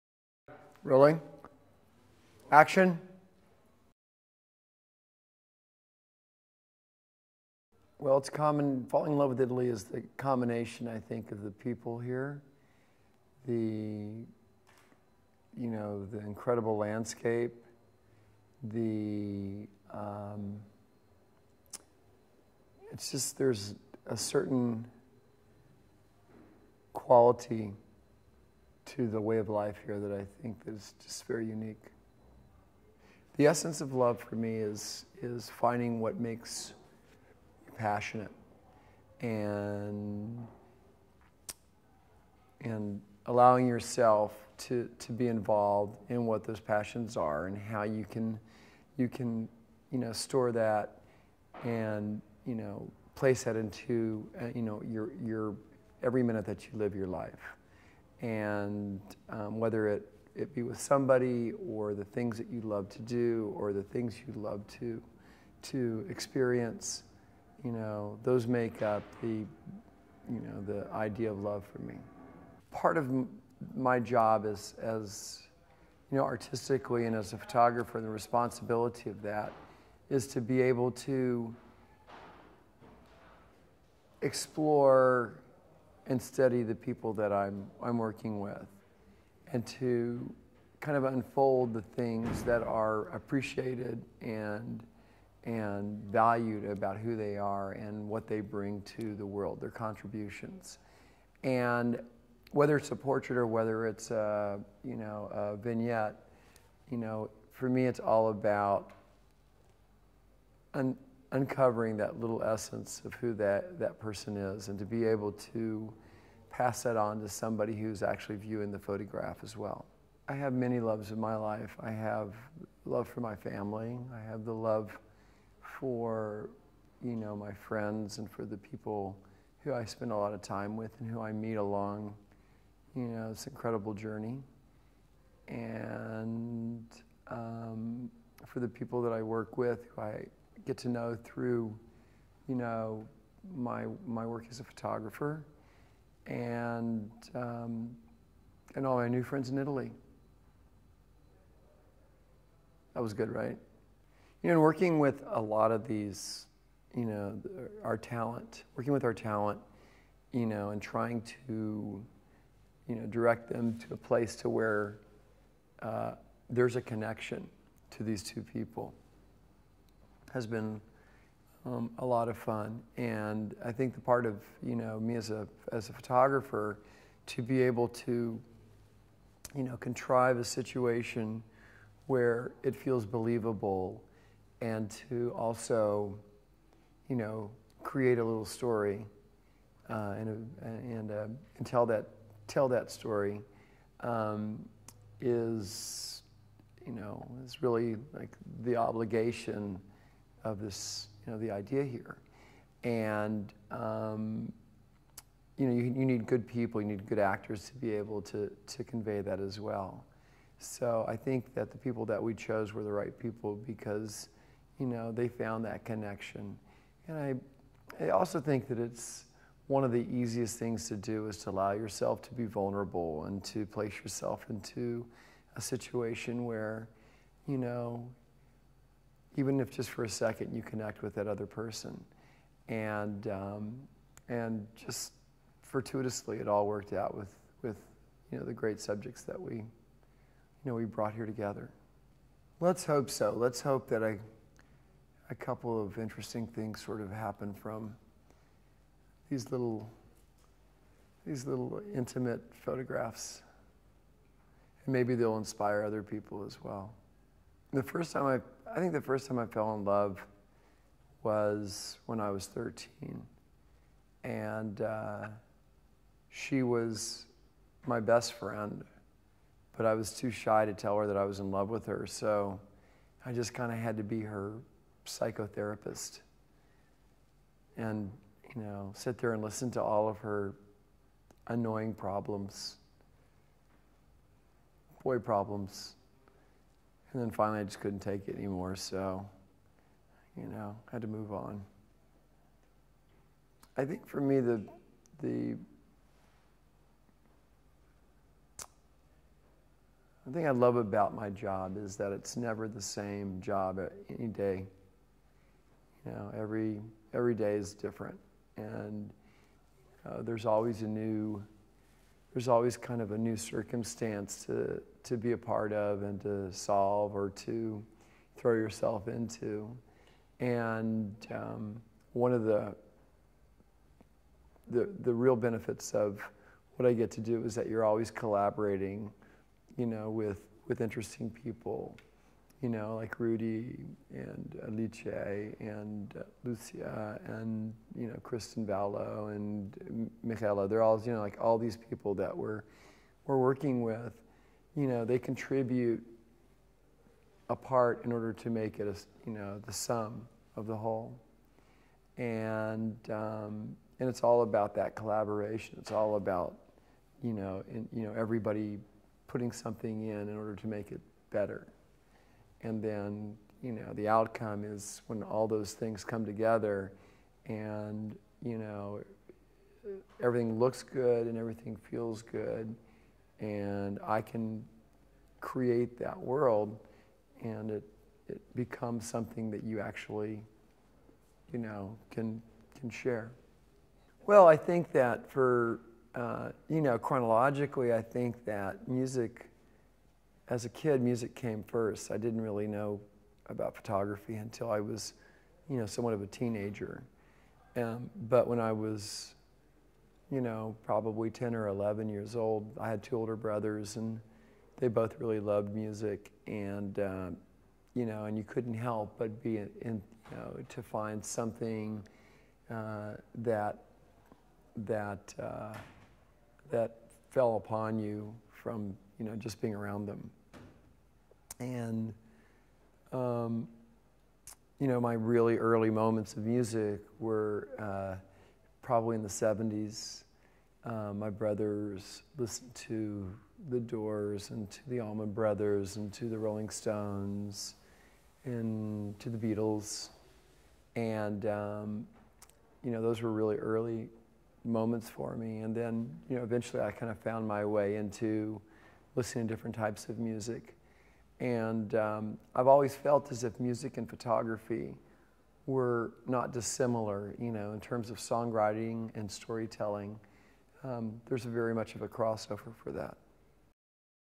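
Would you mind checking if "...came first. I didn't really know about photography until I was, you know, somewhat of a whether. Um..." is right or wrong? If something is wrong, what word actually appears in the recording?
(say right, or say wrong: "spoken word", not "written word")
wrong: "teenager", not "whether".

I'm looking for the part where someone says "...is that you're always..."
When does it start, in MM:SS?
05:27.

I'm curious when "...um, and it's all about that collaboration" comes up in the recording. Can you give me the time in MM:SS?
05:53.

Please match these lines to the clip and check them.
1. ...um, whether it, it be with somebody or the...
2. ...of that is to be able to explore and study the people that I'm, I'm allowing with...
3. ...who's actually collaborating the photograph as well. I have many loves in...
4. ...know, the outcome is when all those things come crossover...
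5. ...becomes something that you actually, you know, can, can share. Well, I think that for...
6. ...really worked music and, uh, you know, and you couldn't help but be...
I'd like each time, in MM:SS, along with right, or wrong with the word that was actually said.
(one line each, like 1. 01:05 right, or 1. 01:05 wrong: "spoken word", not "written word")
1. 00:59 right
2. 01:19 wrong: "working", not "allowing"
3. 01:57 wrong: "viewing", not "collaborating"
4. 06:03 wrong: "together", not "crossover"
5. 06:18 right
6. 06:45 wrong: "loved", not "worked".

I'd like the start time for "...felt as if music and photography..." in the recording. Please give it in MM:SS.
07:32.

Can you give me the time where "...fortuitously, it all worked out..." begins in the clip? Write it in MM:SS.
03:55.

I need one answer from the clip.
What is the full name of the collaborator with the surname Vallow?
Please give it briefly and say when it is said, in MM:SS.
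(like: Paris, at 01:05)
Kristen Vallow, at 05:38.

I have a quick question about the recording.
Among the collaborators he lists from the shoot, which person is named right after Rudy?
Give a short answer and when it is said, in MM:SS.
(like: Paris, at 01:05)
Alice, at 05:34.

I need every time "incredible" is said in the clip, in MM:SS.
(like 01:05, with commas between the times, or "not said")
00:16, 02:13.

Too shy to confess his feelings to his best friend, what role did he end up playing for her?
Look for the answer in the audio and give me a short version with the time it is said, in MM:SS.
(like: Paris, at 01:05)
psychotherapist, at 04:35.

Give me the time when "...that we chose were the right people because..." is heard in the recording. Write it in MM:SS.
03:32.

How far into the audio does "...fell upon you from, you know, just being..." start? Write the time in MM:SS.
06:57.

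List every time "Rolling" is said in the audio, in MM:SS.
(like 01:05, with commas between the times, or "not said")
00:00, 07:16.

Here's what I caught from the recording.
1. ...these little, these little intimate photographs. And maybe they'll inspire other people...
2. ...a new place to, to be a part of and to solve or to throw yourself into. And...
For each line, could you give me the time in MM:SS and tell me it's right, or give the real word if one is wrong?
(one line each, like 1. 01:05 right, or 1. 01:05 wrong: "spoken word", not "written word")
1. 04:09 right
2. 05:13 wrong: "circumstance", not "place".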